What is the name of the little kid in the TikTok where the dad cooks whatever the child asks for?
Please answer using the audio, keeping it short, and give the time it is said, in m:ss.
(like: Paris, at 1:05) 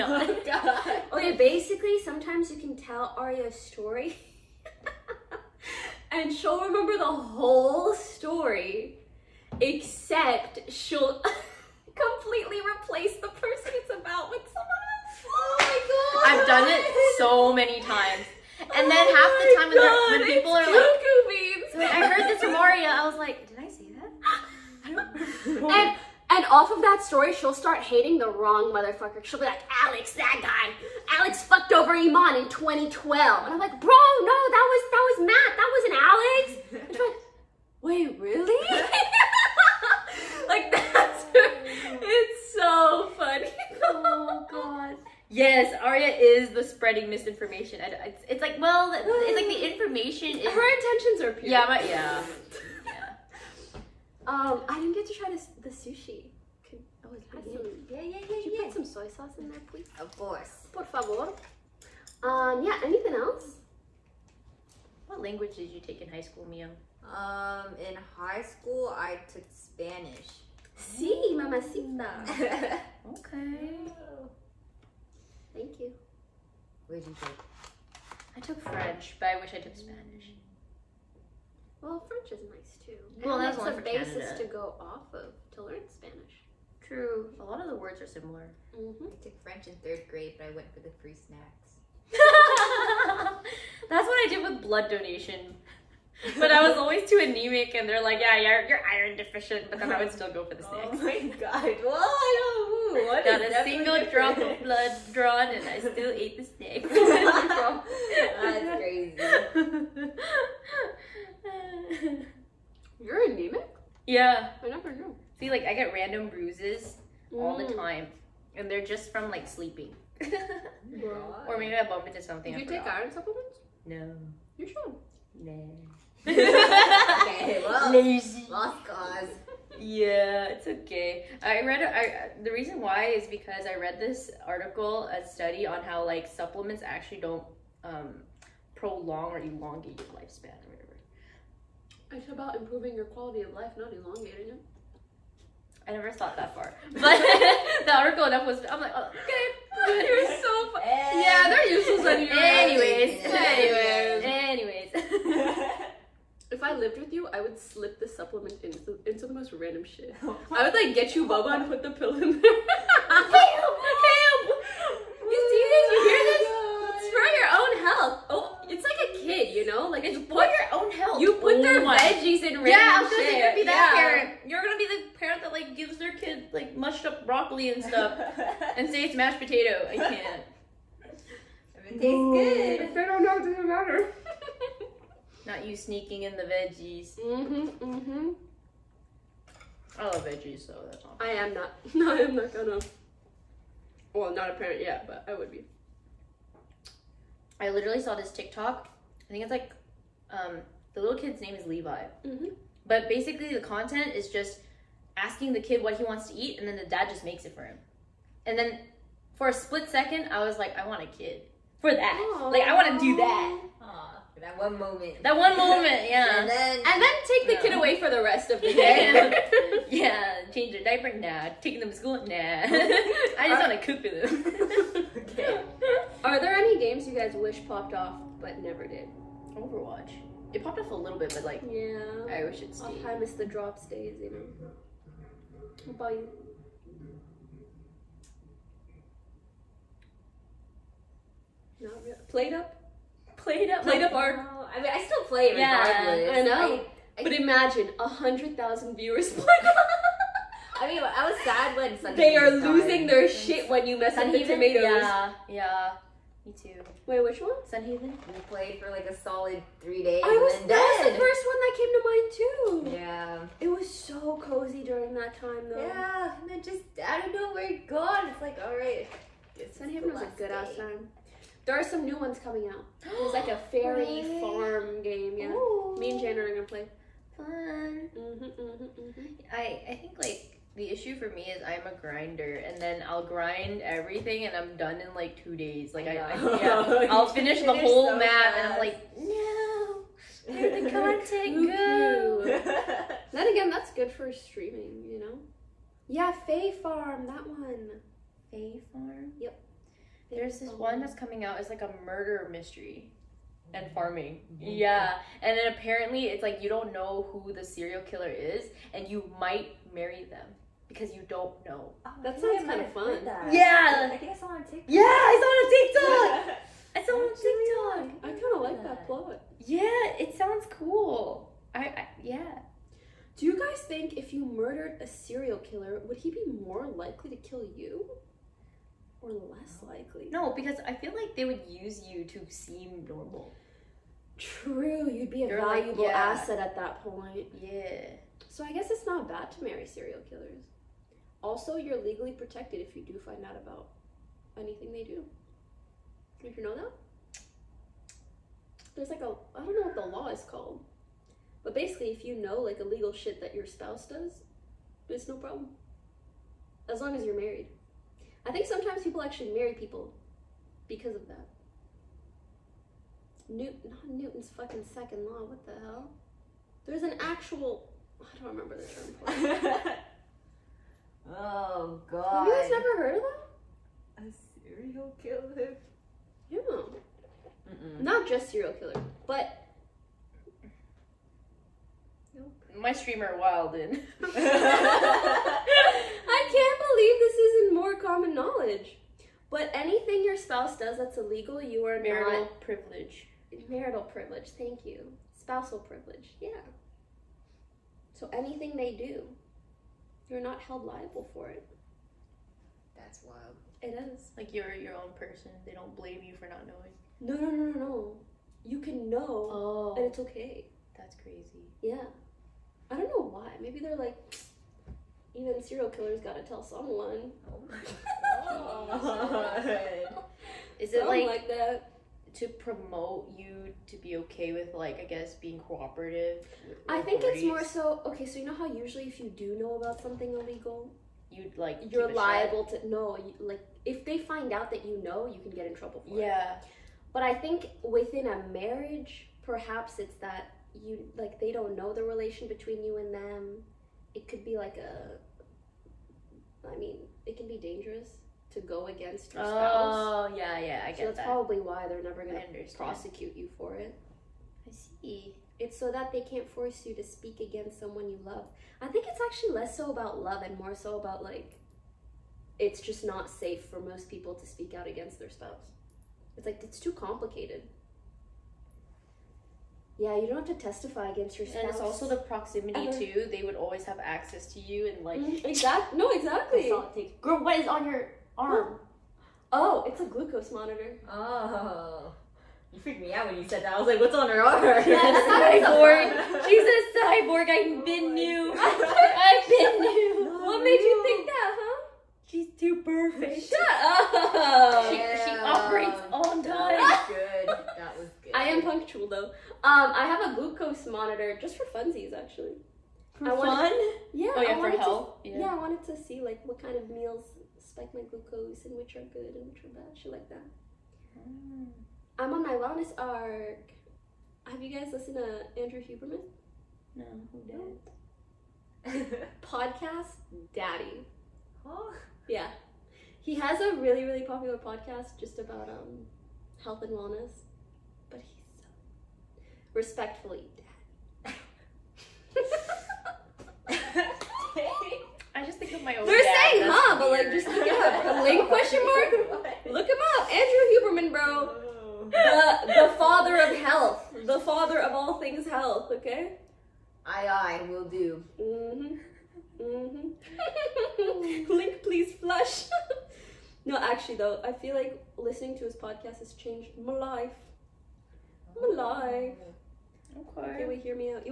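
Levi, at 3:21.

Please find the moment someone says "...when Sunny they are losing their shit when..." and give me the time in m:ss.
4:11.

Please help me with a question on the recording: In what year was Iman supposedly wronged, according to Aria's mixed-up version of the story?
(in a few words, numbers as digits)
2012.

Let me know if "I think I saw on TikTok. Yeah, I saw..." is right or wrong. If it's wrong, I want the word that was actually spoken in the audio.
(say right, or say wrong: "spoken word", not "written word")
right.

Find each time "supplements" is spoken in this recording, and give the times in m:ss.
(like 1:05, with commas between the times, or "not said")
2:03, 2:16, 2:38.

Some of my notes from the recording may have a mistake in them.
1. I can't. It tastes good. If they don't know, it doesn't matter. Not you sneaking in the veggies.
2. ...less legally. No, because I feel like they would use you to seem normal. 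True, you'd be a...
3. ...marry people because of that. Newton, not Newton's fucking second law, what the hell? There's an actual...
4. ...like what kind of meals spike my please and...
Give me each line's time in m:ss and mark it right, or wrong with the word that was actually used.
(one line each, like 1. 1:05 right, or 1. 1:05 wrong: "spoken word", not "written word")
1. 2:59 right
2. 5:29 wrong: "likely", not "legally"
3. 5:59 right
4. 8:26 wrong: "glucose", not "please".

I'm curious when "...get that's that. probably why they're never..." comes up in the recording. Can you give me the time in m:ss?
7:30.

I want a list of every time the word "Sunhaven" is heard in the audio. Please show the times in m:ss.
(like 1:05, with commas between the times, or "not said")
4:17, 4:29.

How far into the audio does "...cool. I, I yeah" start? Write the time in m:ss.
5:20.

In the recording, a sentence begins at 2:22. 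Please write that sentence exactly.
It's about improving your quality of life, not elongating it.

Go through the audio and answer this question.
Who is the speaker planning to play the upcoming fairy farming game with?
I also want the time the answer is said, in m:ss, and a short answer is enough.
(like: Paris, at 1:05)
Jana, at 4:36.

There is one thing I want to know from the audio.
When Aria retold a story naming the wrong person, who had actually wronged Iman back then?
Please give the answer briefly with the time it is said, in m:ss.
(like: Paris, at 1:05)
Matt, at 0:35.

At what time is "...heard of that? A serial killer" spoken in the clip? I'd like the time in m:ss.
6:12.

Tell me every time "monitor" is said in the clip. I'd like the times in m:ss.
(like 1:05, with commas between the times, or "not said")
8:00, 8:20.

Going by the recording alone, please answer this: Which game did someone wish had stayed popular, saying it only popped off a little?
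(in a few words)
Overwatch.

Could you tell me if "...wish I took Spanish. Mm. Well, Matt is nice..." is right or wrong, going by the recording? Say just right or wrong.
wrong.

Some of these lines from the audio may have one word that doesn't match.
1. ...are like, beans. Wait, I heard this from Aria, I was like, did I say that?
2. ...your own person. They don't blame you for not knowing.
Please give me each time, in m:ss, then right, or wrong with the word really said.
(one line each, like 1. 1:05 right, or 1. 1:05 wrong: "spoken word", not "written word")
1. 0:20 right
2. 6:44 right.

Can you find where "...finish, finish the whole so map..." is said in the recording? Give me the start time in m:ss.
4:47.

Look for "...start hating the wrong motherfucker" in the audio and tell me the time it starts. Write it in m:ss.
0:27.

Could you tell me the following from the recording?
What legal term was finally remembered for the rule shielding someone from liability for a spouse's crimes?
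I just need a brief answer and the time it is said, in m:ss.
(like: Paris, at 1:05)
Marital privilege, at 6:33.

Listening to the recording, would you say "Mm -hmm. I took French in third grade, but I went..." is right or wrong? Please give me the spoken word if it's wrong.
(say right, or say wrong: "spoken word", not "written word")
right.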